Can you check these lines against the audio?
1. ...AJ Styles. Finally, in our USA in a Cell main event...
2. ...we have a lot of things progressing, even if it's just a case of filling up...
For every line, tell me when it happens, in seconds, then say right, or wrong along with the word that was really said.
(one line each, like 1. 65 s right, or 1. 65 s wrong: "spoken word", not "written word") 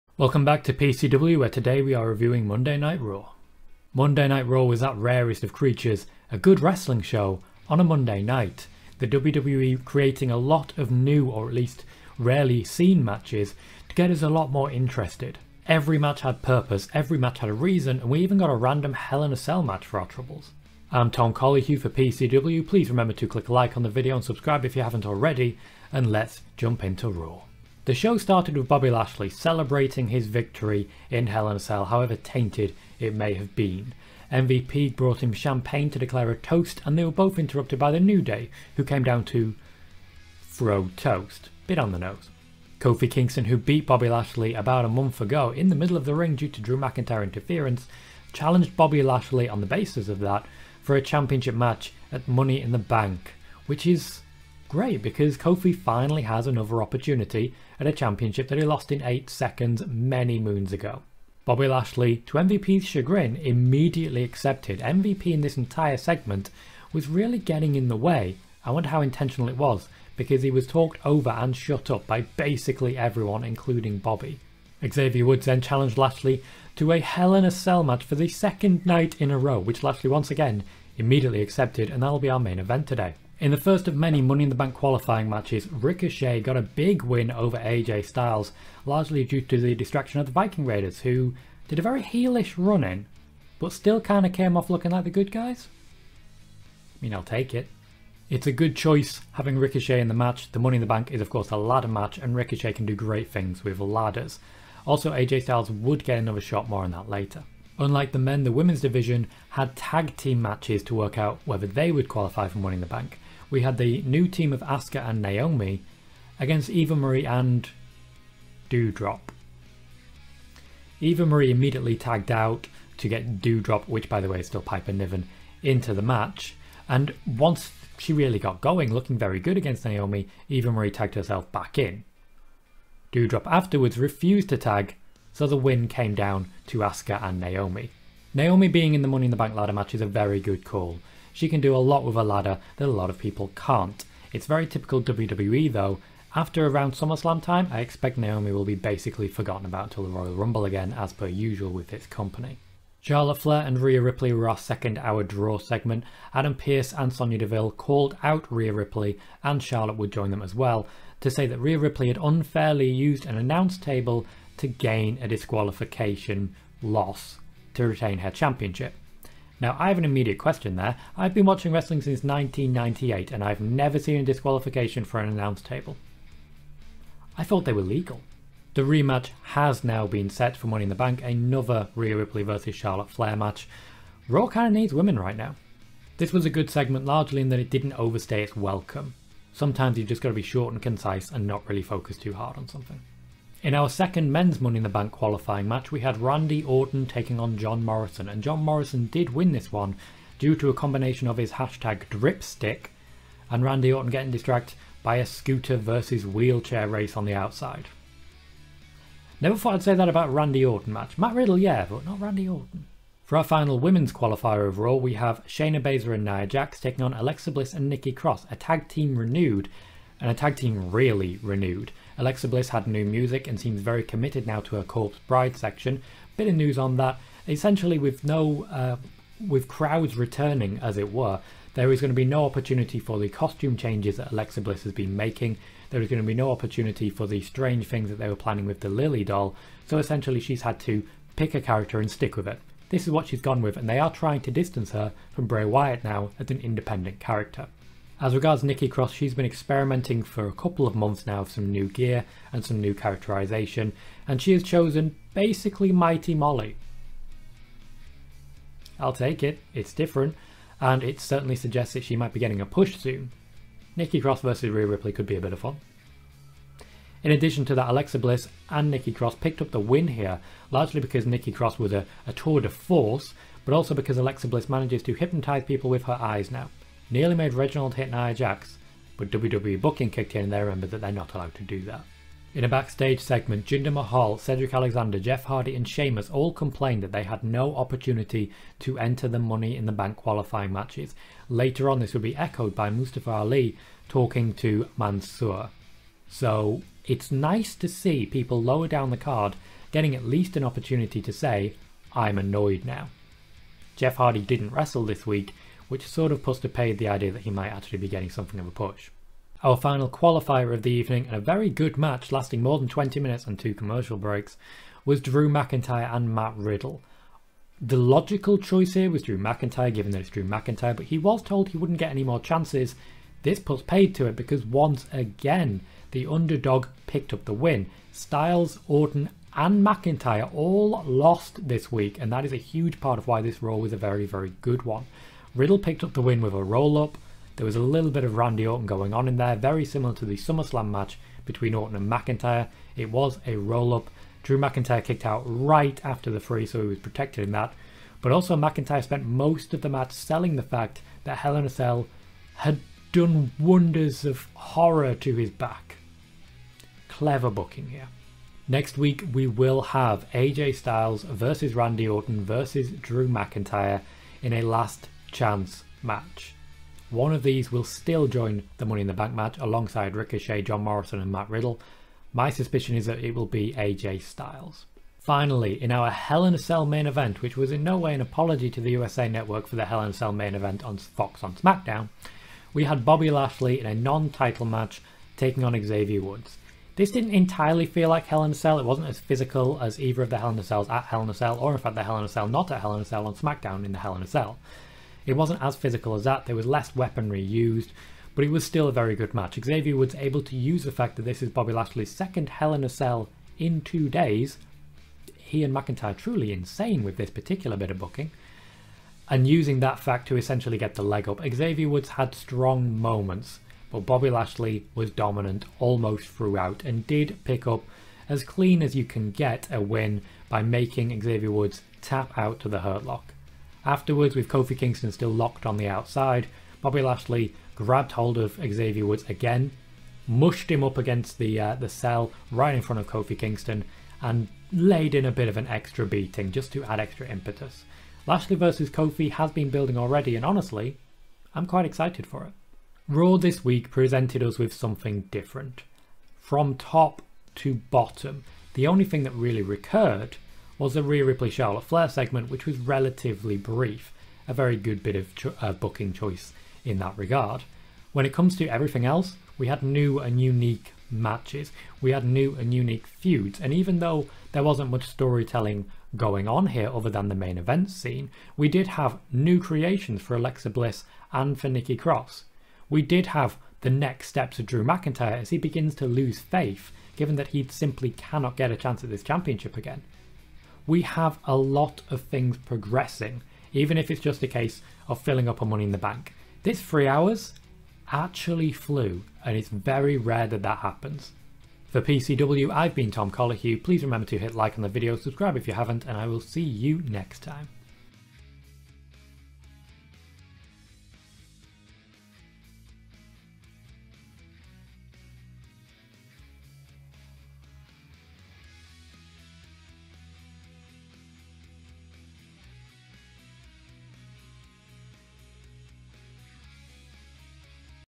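1. 373 s wrong: "Hell", not "USA"
2. 480 s right.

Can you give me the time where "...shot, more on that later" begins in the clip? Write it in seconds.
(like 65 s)
106 s.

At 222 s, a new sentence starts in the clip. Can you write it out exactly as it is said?
Alexa Bliss had new music and seems very committed now to her Corpse Bride section.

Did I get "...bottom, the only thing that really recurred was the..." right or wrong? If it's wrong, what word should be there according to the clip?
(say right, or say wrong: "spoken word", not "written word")
right.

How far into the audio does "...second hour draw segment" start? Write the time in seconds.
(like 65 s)
154 s.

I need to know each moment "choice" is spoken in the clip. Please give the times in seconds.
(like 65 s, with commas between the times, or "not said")
98 s, 318 s, 456 s.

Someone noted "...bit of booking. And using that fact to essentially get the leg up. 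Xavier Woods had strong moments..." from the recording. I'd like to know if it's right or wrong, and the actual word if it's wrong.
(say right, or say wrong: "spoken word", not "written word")
right.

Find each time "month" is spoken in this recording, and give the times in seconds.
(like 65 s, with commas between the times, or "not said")
44 s, 250 s.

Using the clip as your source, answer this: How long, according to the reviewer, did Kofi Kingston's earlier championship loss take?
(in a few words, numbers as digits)
8 seconds.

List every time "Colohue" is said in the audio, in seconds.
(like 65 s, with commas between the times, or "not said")
21 s, 493 s.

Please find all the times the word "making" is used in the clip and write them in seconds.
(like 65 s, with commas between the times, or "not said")
235 s, 420 s.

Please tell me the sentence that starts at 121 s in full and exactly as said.
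Eva Marie immediately tagged out to get Doudrop, which by the way is still Piper Niven, into the match.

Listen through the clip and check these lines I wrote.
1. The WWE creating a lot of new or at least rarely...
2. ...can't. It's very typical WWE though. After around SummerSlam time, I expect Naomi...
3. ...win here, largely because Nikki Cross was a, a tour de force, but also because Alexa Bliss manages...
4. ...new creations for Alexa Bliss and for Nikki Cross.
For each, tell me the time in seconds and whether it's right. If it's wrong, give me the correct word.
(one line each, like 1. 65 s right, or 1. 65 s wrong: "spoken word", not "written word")
1. 8 s right
2. 143 s right
3. 269 s right
4. 469 s right.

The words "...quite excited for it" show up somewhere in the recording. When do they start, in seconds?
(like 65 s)
441 s.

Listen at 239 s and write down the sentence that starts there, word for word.
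So essentially, she's had to pick a character and stick with it.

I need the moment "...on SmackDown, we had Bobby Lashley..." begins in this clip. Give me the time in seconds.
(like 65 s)
381 s.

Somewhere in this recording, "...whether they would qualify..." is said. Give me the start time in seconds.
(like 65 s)
111 s.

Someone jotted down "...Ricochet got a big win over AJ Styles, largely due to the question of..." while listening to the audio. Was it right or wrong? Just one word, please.
wrong.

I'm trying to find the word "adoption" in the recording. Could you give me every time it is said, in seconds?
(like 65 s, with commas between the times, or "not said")
not said.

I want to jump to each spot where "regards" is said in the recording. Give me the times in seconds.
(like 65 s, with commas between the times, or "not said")
248 s, 457 s.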